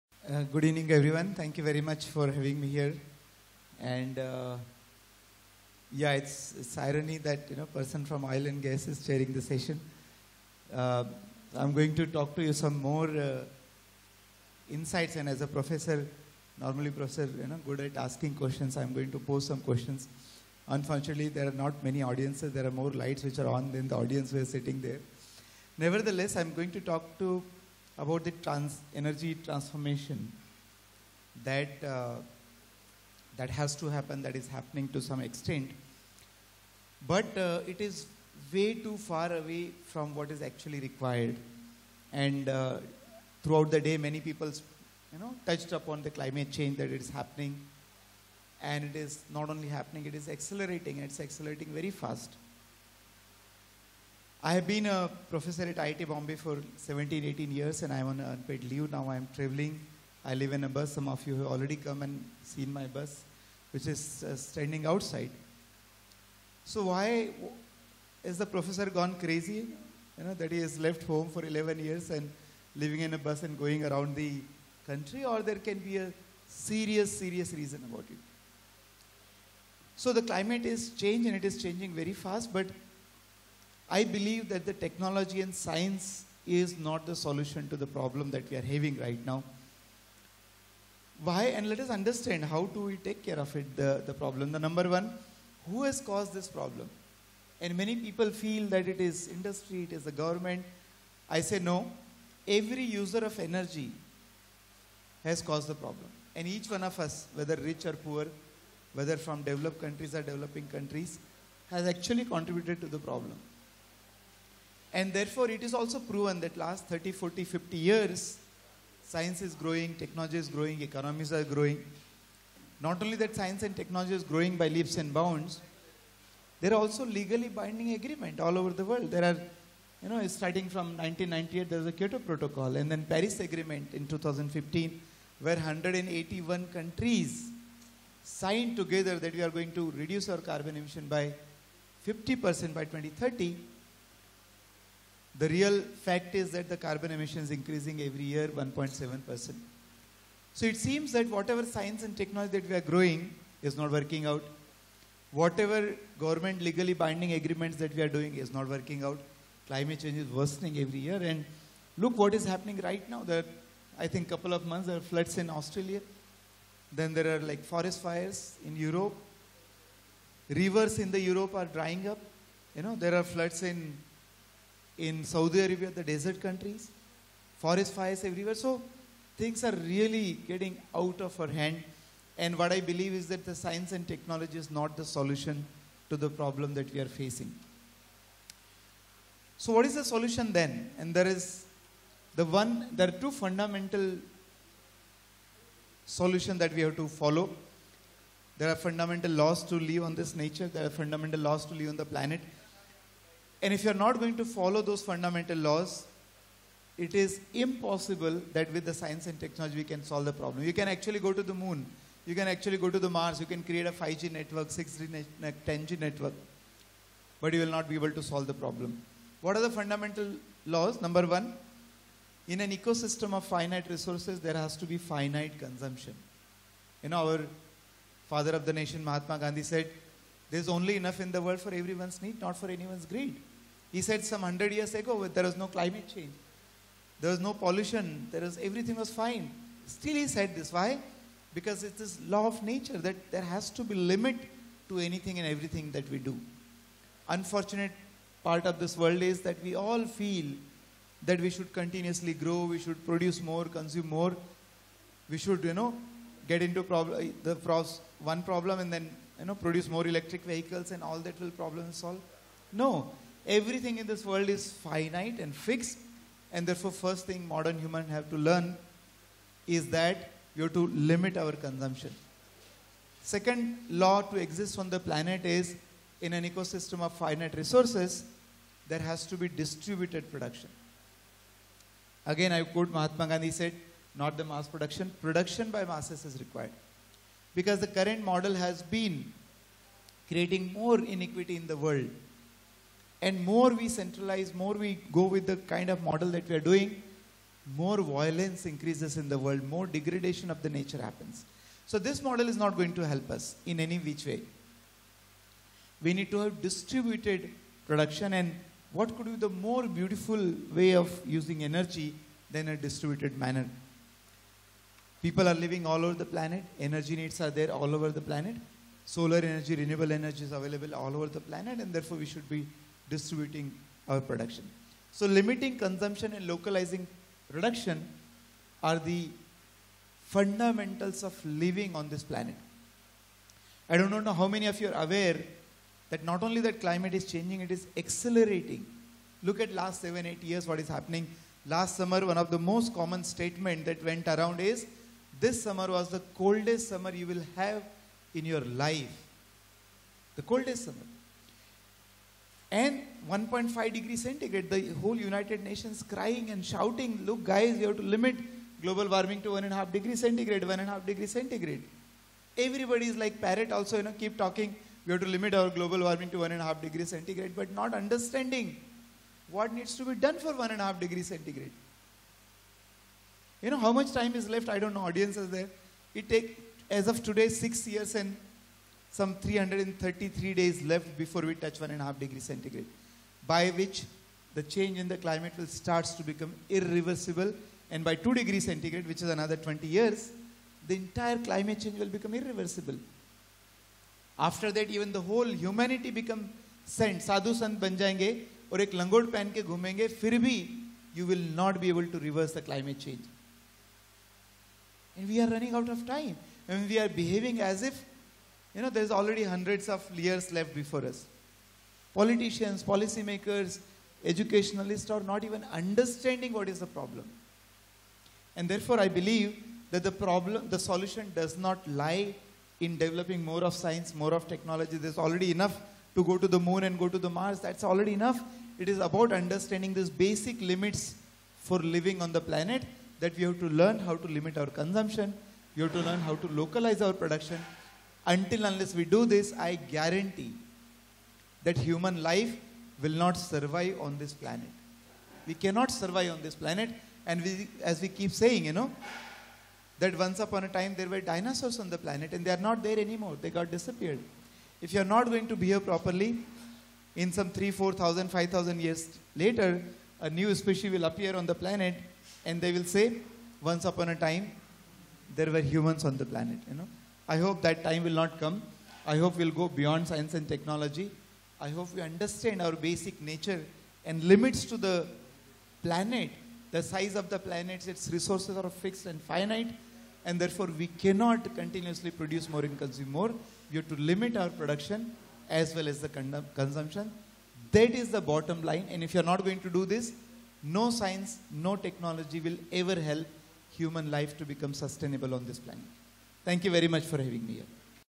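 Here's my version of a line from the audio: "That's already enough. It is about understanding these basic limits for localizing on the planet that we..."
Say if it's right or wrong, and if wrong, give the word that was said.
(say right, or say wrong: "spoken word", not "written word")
wrong: "living", not "localizing".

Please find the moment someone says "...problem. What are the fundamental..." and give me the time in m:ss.
3:38.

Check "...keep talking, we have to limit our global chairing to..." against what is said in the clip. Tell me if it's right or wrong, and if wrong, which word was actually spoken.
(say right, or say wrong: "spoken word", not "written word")
wrong: "warming", not "chairing".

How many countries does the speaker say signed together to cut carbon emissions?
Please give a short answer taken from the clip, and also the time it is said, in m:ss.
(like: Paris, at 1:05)
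181, at 2:15.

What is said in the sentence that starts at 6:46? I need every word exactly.
रनिंग आउट ऑफ टाइम एंड वी you know, there's already hundreds of years left before us.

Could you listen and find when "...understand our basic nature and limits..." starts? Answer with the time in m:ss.
7:52.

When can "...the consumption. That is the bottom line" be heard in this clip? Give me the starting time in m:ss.
8:06.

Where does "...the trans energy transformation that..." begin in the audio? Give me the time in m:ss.
0:28.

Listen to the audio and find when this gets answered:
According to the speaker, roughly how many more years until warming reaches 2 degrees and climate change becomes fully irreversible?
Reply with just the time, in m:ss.
6:29.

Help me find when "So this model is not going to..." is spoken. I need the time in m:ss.
5:01.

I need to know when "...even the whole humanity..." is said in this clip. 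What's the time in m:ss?
6:34.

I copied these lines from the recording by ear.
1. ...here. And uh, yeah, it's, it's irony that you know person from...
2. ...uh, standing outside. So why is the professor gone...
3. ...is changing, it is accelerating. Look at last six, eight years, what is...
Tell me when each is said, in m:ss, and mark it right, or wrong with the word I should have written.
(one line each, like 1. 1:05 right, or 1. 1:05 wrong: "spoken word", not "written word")
1. 0:02 right
2. 1:04 right
3. 5:37 wrong: "seven", not "six".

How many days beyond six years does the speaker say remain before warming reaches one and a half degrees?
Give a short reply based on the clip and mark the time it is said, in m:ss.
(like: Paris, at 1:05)
333, at 6:19.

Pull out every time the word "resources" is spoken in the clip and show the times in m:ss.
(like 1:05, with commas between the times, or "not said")
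3:43, 4:37, 7:58.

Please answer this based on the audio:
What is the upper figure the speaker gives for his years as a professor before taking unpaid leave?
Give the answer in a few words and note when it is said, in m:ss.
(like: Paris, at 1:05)
18, at 0:57.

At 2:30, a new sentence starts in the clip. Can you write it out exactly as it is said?
So it seems that whatever science and technology that we are growing is not working out.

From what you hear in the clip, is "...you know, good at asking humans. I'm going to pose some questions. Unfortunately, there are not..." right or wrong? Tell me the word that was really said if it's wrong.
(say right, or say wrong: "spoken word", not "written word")
wrong: "questions", not "humans".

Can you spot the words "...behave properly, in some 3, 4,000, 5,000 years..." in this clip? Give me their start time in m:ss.
7:35.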